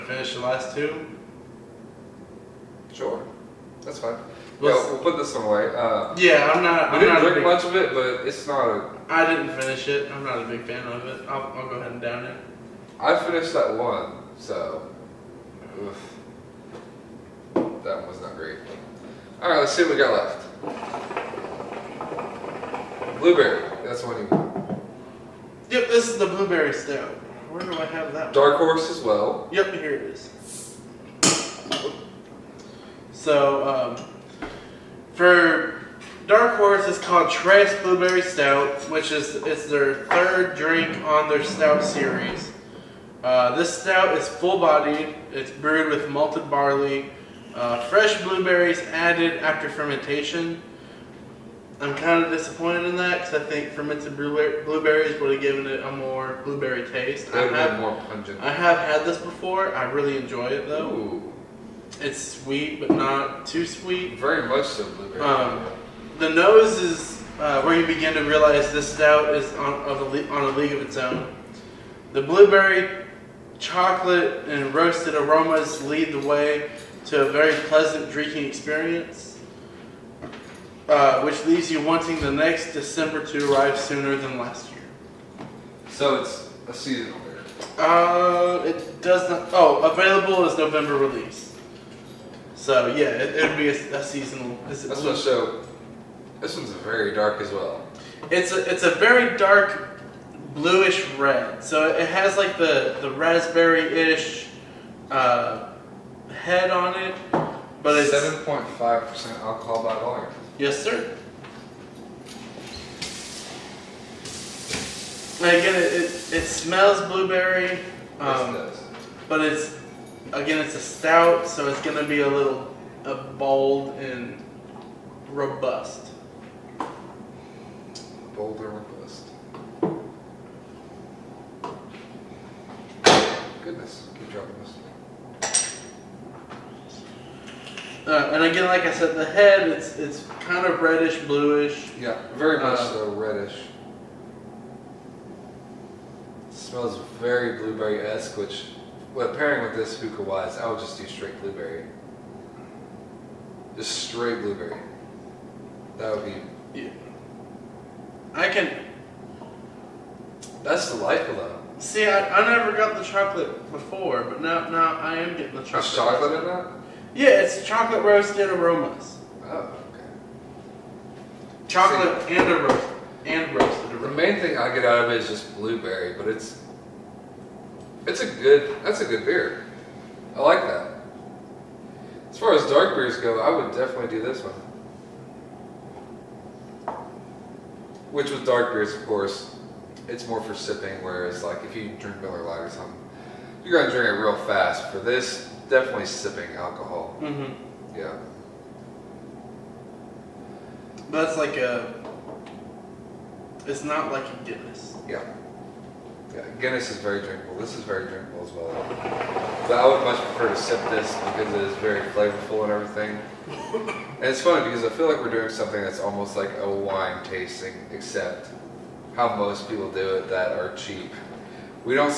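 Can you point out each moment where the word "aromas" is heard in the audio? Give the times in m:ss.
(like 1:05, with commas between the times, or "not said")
1:15, 2:48, 2:53.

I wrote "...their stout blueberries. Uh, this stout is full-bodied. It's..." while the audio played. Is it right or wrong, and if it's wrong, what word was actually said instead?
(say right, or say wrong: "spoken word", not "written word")
wrong: "series", not "blueberries".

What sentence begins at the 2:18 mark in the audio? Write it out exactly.
Uh, and again, like I said, the head, it's it's kind of reddish, bluish.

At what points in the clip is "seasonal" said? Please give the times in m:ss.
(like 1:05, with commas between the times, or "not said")
1:26, 1:34.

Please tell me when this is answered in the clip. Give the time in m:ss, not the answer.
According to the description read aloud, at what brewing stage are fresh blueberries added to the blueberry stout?
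0:49.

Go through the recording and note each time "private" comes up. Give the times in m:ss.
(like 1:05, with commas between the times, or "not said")
not said.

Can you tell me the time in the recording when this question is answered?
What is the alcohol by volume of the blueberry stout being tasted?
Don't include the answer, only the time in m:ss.
1:48.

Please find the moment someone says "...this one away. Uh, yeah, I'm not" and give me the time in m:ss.
0:05.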